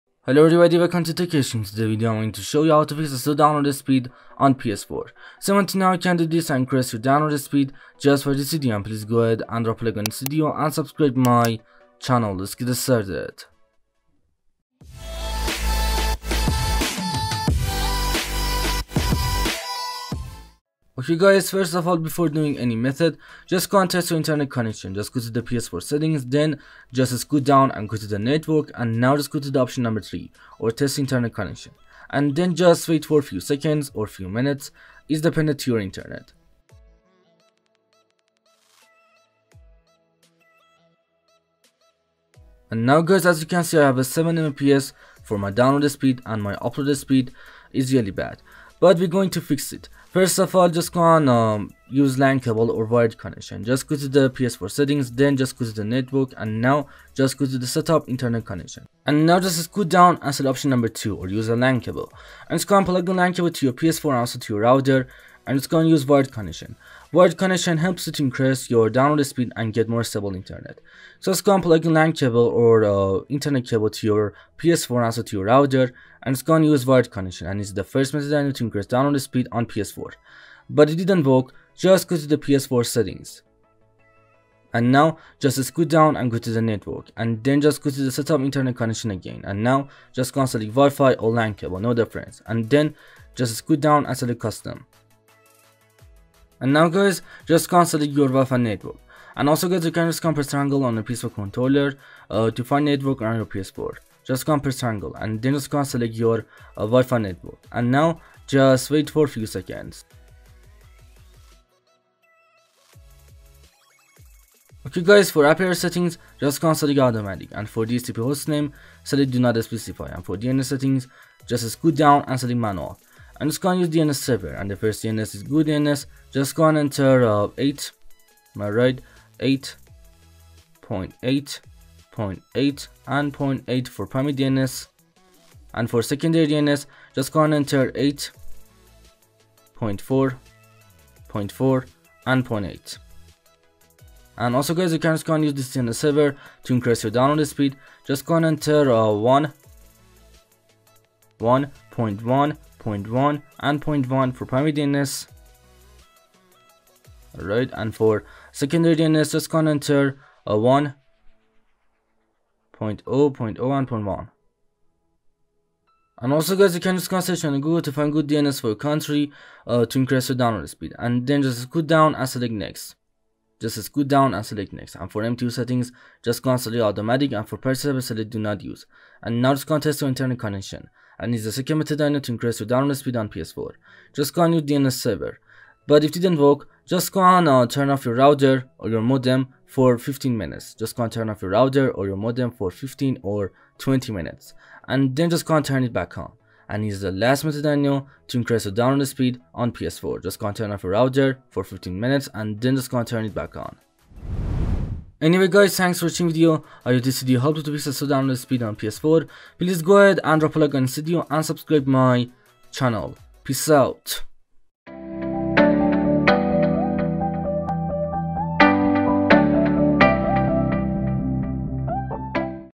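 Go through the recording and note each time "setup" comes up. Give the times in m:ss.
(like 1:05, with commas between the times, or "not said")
0:57, 1:28.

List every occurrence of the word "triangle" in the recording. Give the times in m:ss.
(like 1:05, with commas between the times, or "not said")
1:40, 1:44.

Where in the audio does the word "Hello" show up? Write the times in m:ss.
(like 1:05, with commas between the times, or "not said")
0:00.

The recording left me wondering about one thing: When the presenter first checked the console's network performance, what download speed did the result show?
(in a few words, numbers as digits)
7 Mbps.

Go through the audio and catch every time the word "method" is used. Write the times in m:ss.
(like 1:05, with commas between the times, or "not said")
0:22, 1:18, 3:01, 3:17.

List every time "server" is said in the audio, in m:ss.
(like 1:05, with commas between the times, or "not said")
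2:04, 2:25, 2:57, 3:04.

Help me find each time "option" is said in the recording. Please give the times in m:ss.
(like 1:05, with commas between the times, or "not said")
0:29, 1:00.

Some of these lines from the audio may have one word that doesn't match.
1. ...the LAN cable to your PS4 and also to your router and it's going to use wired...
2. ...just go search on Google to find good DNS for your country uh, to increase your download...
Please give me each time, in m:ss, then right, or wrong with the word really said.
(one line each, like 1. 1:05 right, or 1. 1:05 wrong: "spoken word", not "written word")
1. 1:03 right
2. 2:46 right.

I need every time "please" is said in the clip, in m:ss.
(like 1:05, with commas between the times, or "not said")
0:08, 3:29.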